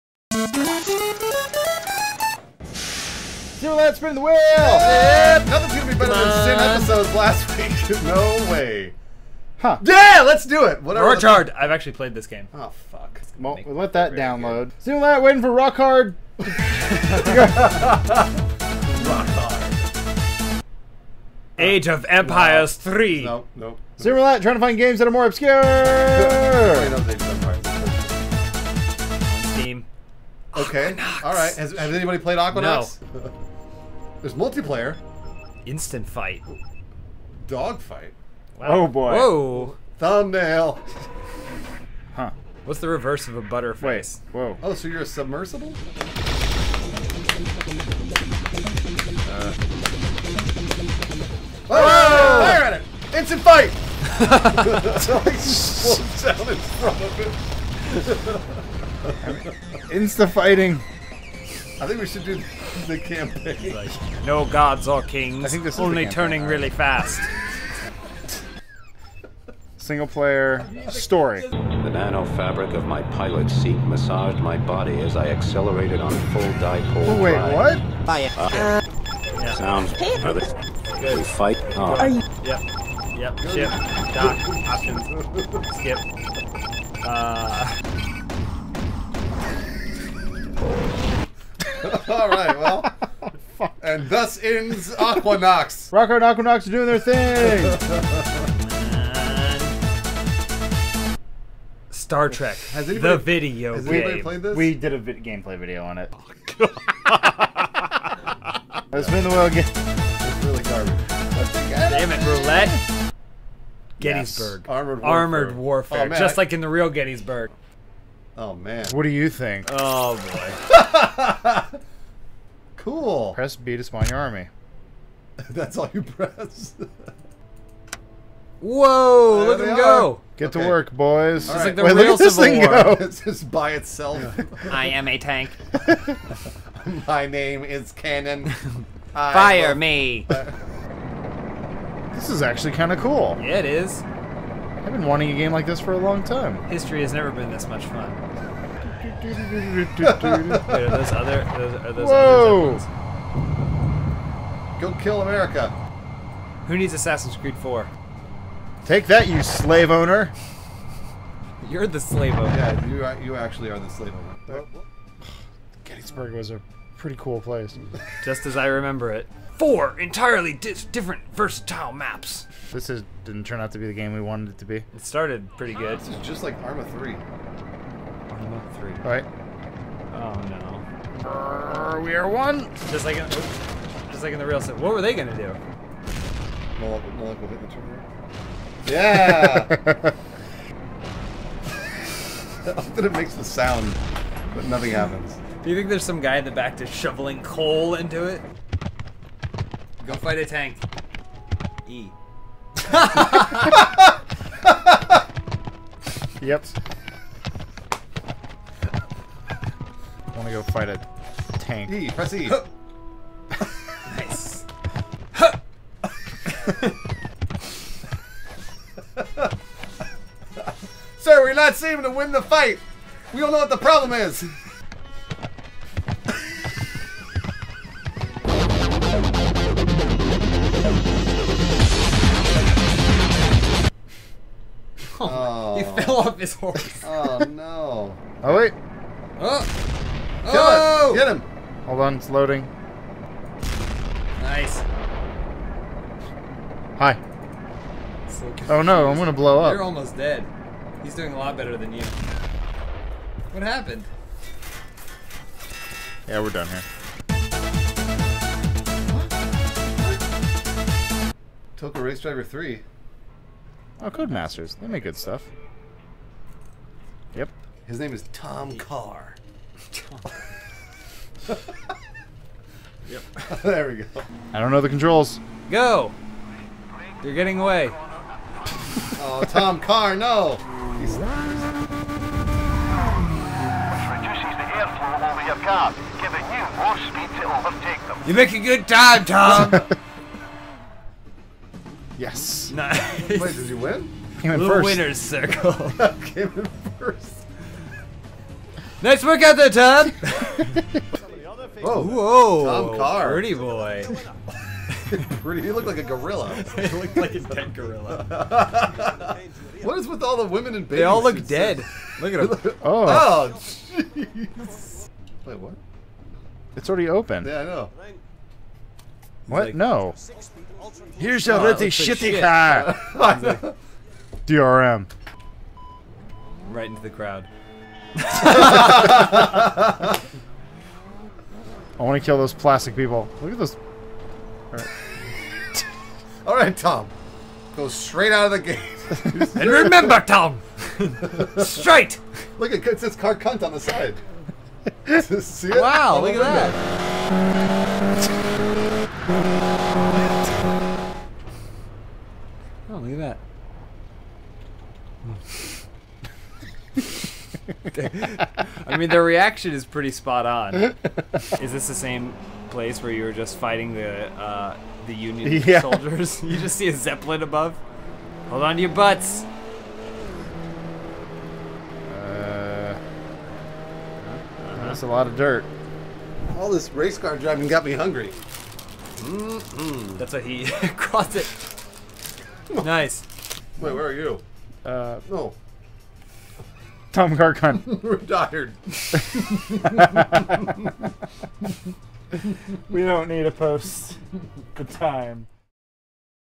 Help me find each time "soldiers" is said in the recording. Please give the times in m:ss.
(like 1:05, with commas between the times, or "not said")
6:05.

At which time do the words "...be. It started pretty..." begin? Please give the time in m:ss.
2:54.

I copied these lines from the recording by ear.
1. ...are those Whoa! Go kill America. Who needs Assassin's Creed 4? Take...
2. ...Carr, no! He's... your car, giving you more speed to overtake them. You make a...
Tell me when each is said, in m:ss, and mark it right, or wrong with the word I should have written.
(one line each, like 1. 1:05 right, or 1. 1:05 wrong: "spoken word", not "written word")
1. 2:31 right
2. 4:39 right.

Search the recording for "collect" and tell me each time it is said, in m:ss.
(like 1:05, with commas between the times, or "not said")
not said.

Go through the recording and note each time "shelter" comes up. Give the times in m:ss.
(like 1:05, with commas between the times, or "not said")
not said.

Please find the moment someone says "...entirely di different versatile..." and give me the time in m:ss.
2:49.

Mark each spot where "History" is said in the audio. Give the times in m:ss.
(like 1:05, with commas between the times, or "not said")
2:26.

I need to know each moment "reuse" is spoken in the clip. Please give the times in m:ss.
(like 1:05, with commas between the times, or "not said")
not said.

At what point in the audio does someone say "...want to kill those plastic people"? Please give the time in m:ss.
5:31.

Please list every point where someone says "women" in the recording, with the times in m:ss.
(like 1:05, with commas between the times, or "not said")
5:10.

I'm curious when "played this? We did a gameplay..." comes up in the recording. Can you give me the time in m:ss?
1:44.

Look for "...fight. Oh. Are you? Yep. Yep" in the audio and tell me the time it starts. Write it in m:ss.
1:21.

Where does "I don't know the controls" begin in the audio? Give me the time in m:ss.
4:34.